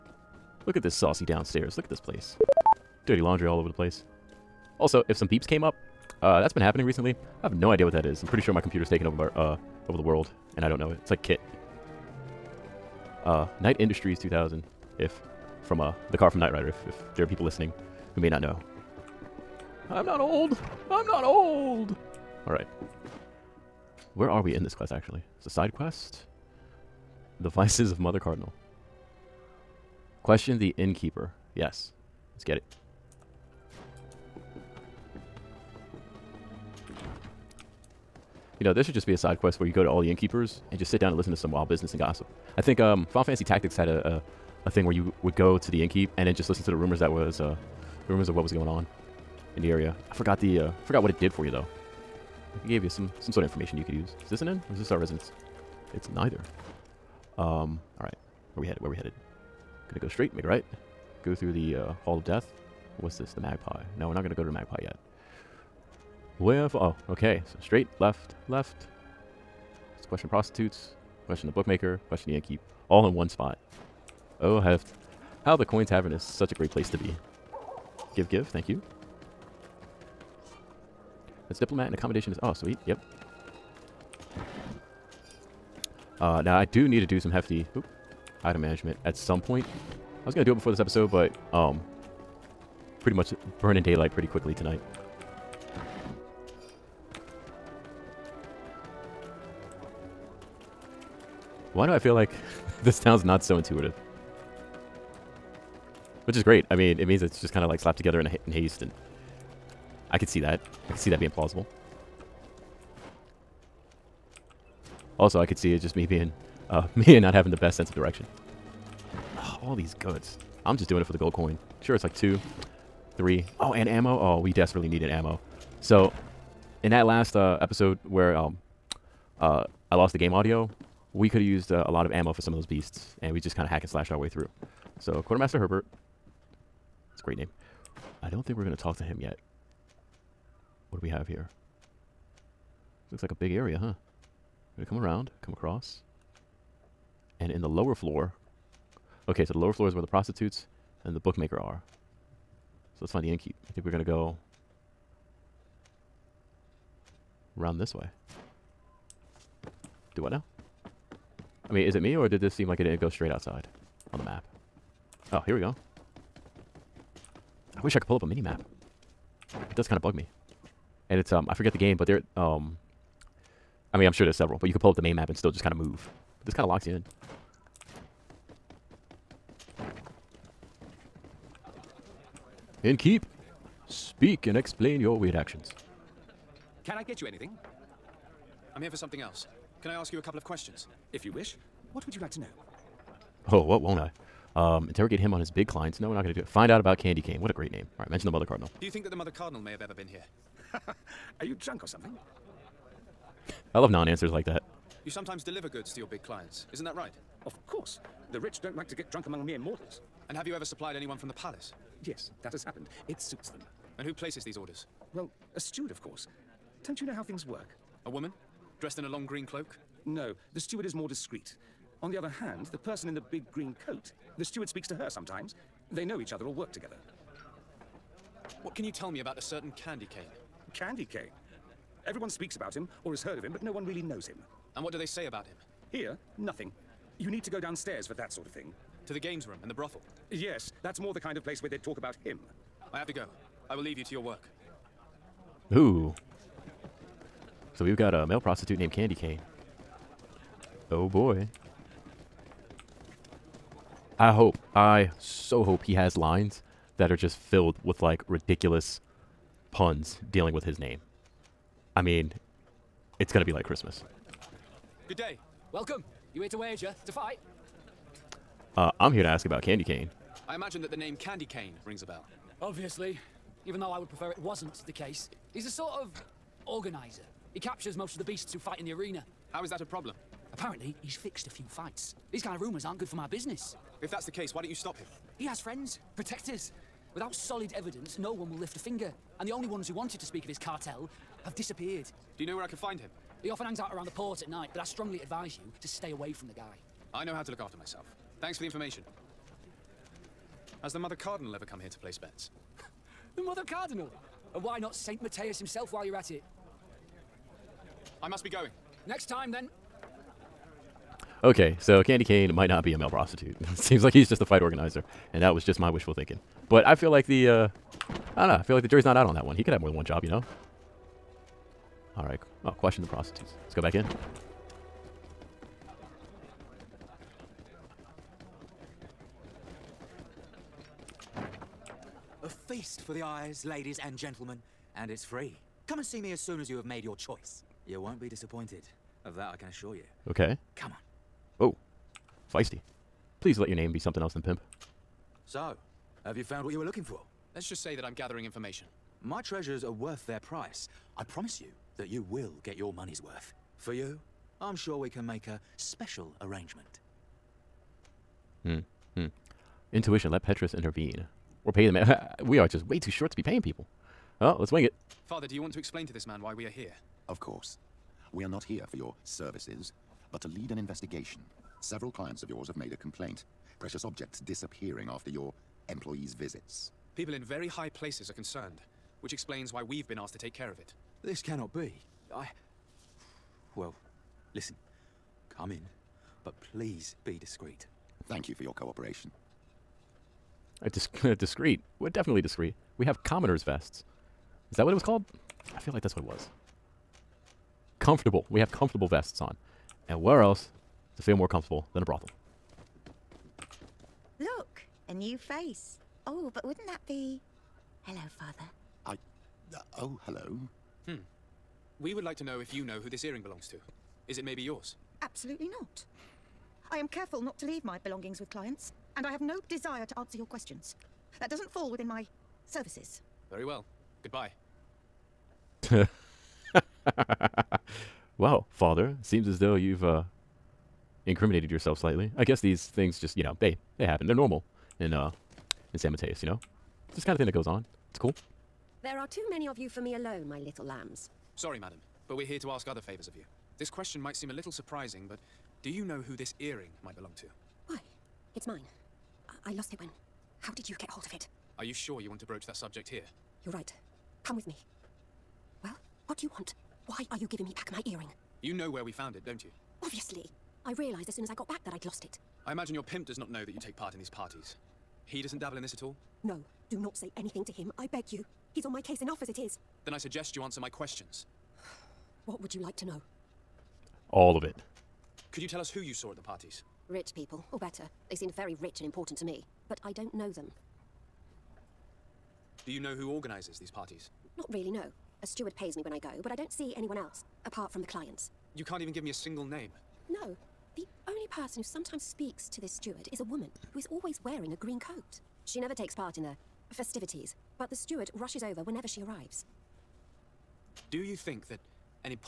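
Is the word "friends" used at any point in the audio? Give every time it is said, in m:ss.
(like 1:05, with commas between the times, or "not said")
4:45.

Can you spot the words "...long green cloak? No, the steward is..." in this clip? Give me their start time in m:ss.
3:39.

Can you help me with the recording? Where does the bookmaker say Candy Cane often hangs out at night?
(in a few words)
the port.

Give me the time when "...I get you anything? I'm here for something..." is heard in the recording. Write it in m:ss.
3:06.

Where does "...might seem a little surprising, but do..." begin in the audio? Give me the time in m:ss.
7:24.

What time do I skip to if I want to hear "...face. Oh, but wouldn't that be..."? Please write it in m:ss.
6:45.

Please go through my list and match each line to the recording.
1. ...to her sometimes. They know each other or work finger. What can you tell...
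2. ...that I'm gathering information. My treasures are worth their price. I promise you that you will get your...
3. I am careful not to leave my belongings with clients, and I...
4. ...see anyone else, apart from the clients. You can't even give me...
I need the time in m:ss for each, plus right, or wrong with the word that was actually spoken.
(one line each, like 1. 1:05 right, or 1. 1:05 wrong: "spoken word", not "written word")
1. 3:44 wrong: "together", not "finger"
2. 5:47 right
3. 6:56 right
4. 8:06 right.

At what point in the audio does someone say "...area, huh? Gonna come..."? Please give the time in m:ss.
2:23.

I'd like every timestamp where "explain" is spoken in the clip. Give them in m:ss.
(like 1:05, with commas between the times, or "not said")
3:04, 6:05, 6:19.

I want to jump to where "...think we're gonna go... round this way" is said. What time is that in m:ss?
2:33.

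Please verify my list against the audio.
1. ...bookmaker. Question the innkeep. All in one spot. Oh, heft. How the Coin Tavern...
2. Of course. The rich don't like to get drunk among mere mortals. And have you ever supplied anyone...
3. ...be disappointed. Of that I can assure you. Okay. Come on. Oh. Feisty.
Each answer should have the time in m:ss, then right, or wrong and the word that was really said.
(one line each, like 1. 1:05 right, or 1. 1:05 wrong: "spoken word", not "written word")
1. 1:11 right
2. 3:27 right
3. 5:38 right.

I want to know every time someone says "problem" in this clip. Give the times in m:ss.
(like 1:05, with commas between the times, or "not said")
4:39.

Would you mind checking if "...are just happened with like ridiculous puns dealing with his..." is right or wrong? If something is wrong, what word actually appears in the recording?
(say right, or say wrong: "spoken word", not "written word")
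wrong: "filled", not "happened".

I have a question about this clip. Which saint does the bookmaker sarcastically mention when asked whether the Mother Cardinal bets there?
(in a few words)
St. Matthias.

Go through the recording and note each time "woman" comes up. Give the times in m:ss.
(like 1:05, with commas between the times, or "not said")
3:38, 8:13.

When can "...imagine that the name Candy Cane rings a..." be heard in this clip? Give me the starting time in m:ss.
4:30.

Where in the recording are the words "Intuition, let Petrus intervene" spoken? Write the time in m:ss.
5:59.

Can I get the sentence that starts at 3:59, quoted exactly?
To the games room and the brothel.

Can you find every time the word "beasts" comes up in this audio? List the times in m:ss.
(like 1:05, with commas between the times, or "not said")
2:12, 4:38.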